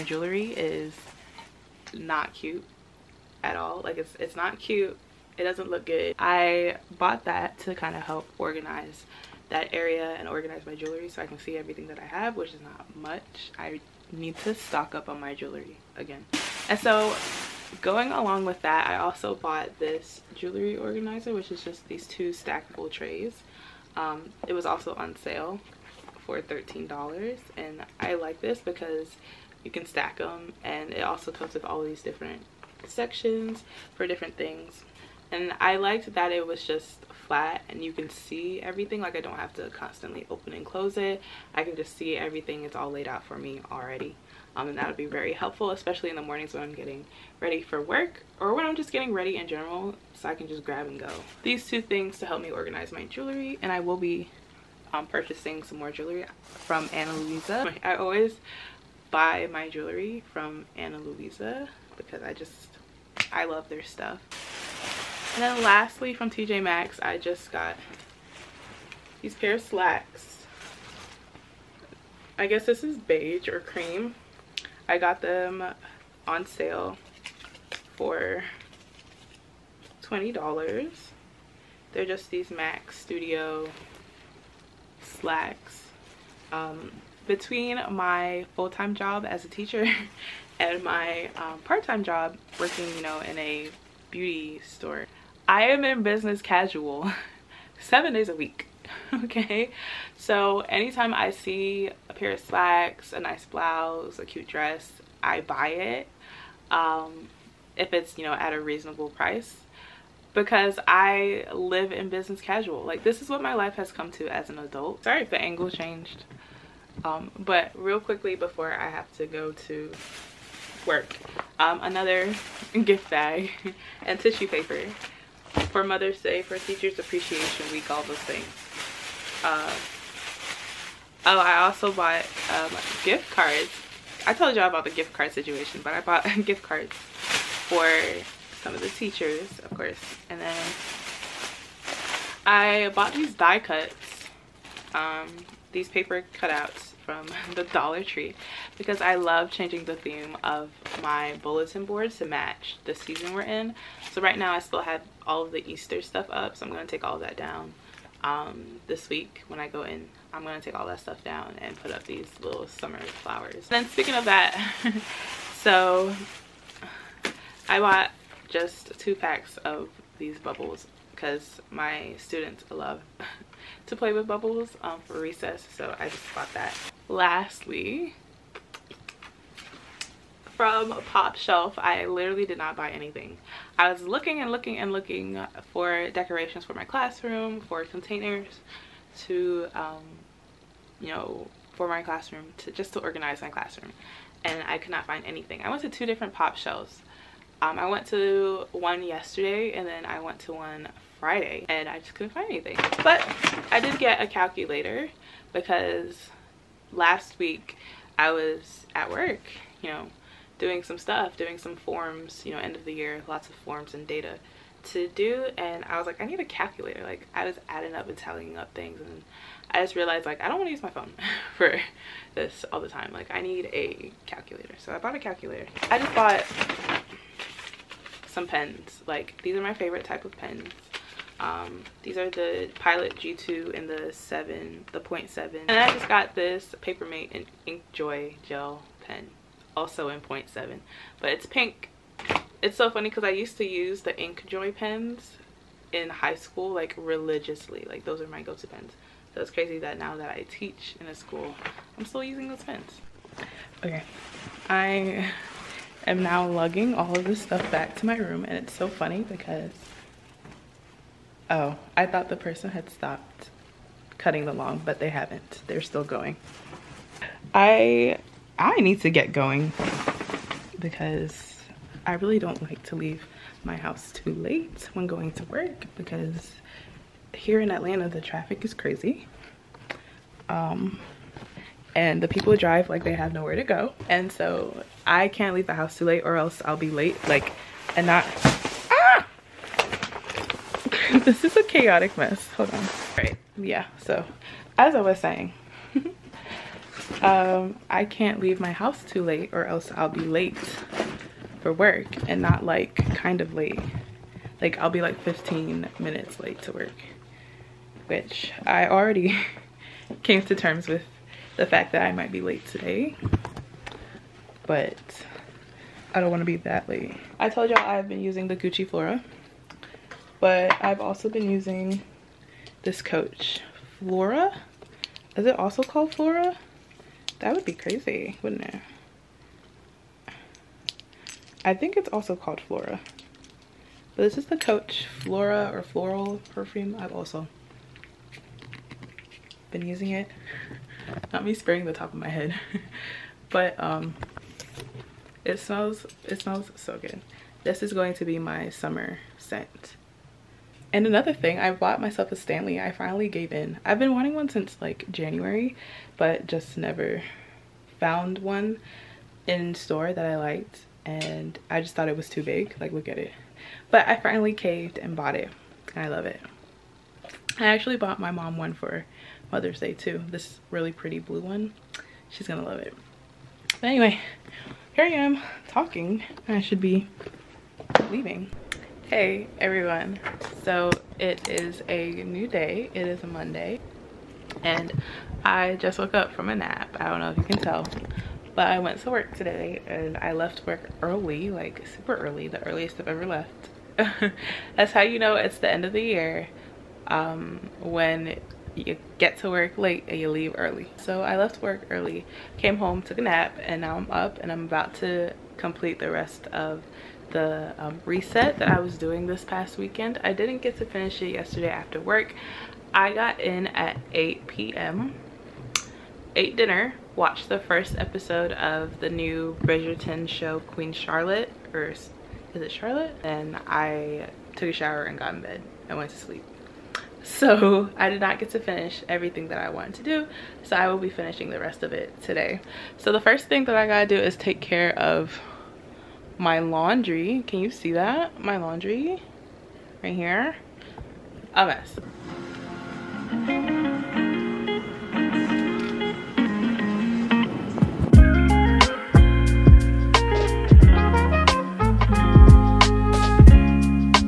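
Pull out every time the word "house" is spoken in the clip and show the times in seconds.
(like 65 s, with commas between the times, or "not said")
273 s, 285 s, 298 s.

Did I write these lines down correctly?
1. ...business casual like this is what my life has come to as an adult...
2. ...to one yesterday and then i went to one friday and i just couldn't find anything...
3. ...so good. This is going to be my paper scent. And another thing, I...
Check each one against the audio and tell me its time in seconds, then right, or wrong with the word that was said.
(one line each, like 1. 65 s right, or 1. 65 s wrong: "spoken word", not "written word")
1. 112 s right
2. 198 s right
3. 346 s wrong: "summer", not "paper".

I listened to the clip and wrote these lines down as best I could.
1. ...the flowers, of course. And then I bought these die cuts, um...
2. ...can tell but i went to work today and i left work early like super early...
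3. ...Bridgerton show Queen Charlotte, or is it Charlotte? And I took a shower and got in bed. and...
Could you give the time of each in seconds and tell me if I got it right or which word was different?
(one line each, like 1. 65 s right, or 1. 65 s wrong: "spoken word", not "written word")
1. 138 s wrong: "teachers", not "flowers"
2. 387 s right
3. 419 s right.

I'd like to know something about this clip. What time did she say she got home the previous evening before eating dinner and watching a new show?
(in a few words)
8 p.m.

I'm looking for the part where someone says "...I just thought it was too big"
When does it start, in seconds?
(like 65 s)
361 s.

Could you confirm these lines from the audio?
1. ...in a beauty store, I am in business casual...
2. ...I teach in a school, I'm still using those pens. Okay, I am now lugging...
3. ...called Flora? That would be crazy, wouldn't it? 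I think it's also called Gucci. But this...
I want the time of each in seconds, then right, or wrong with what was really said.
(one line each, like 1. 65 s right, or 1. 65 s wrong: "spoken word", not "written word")
1. 93 s right
2. 250 s right
3. 325 s wrong: "Flora", not "Gucci".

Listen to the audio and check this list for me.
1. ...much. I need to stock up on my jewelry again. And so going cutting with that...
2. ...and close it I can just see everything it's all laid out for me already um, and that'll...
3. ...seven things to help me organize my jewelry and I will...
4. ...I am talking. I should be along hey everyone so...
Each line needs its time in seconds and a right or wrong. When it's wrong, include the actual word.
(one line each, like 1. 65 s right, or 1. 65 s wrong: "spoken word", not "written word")
1. 12 s wrong: "along", not "cutting"
2. 40 s right
3. 51 s wrong: "two", not "seven"
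4. 375 s wrong: "leaving", not "along".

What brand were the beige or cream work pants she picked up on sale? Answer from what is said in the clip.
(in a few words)
Max Studio.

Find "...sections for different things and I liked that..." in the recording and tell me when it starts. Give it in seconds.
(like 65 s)
32 s.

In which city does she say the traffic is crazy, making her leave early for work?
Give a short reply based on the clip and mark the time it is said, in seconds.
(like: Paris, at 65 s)
Atlanta, at 277 s.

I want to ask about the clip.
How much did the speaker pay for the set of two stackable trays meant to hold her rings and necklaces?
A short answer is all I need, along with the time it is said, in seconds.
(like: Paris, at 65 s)
$13, at 26 s.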